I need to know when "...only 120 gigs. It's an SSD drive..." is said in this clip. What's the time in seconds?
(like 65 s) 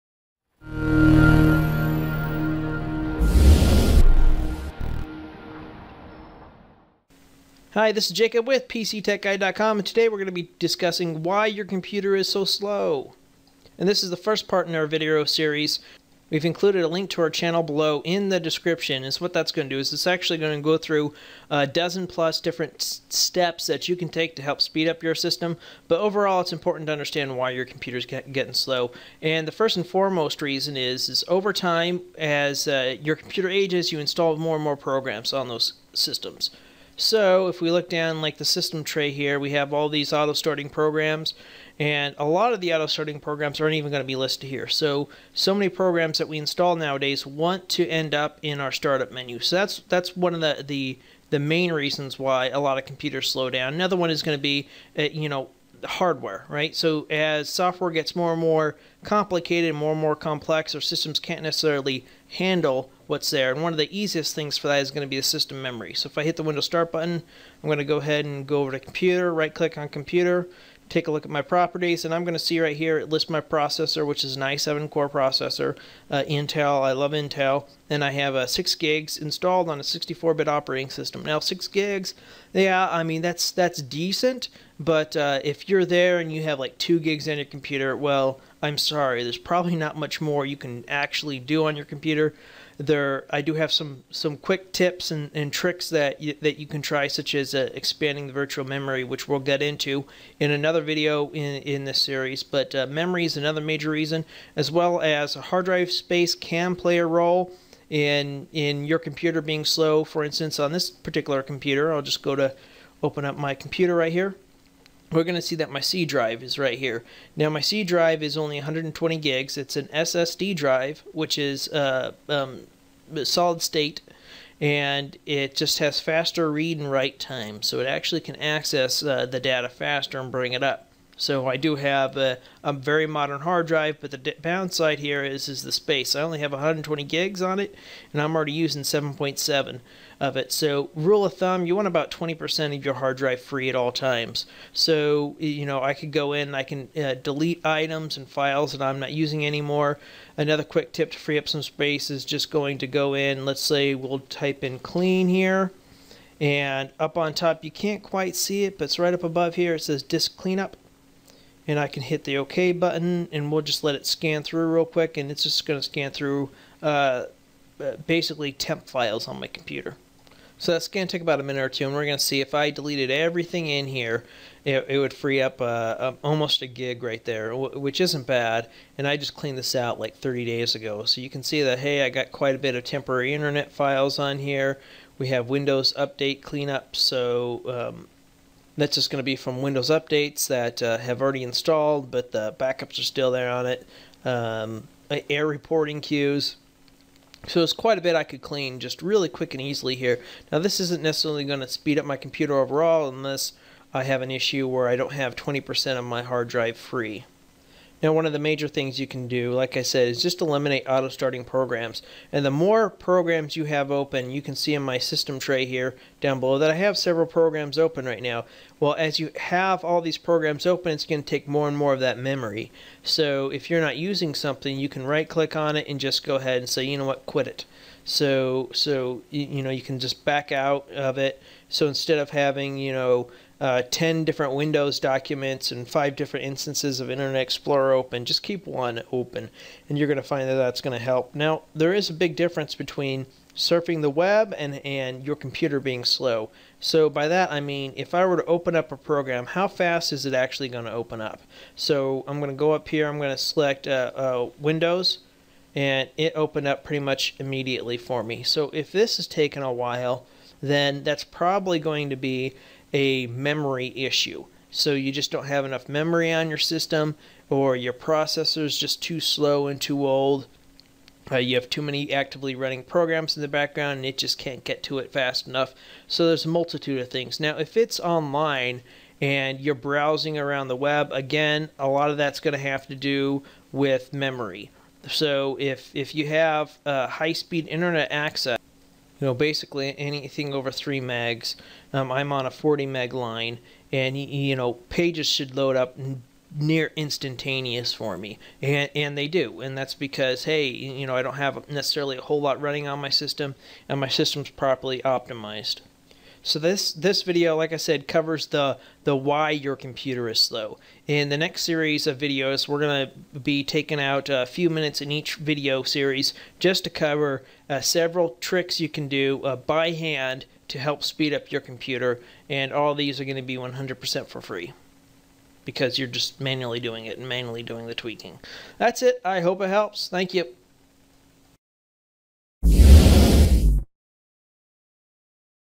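118 s.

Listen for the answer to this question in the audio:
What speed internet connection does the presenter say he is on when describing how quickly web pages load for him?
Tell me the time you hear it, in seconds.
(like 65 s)
292 s.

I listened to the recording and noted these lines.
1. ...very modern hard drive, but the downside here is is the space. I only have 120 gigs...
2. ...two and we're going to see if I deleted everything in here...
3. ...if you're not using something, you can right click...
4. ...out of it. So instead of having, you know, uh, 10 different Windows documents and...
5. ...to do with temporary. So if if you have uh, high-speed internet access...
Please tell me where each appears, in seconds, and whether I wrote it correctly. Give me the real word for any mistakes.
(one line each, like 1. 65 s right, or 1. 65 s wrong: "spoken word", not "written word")
1. 132 s right
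2. 171 s right
3. 223 s right
4. 230 s right
5. 282 s wrong: "memory", not "temporary".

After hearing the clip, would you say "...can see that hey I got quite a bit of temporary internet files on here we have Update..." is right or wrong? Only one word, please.
wrong.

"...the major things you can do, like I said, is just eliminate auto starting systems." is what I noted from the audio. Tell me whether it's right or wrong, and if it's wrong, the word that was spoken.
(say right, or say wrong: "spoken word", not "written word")
wrong: "programs", not "systems".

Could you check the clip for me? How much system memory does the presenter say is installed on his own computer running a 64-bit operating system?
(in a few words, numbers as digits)
6 gigs.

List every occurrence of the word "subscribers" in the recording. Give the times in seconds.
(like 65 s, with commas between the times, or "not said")
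not said.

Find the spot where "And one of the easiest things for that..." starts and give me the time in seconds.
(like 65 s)
63 s.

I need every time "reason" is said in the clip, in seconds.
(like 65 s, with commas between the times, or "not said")
30 s, 51 s, 103 s.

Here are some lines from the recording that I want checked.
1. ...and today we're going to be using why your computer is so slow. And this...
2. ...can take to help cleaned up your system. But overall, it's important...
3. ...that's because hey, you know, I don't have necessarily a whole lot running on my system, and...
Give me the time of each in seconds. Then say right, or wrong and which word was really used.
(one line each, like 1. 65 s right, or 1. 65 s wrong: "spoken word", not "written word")
1. 9 s wrong: "discussing", not "using"
2. 23 s wrong: "speed", not "cleaned"
3. 299 s right.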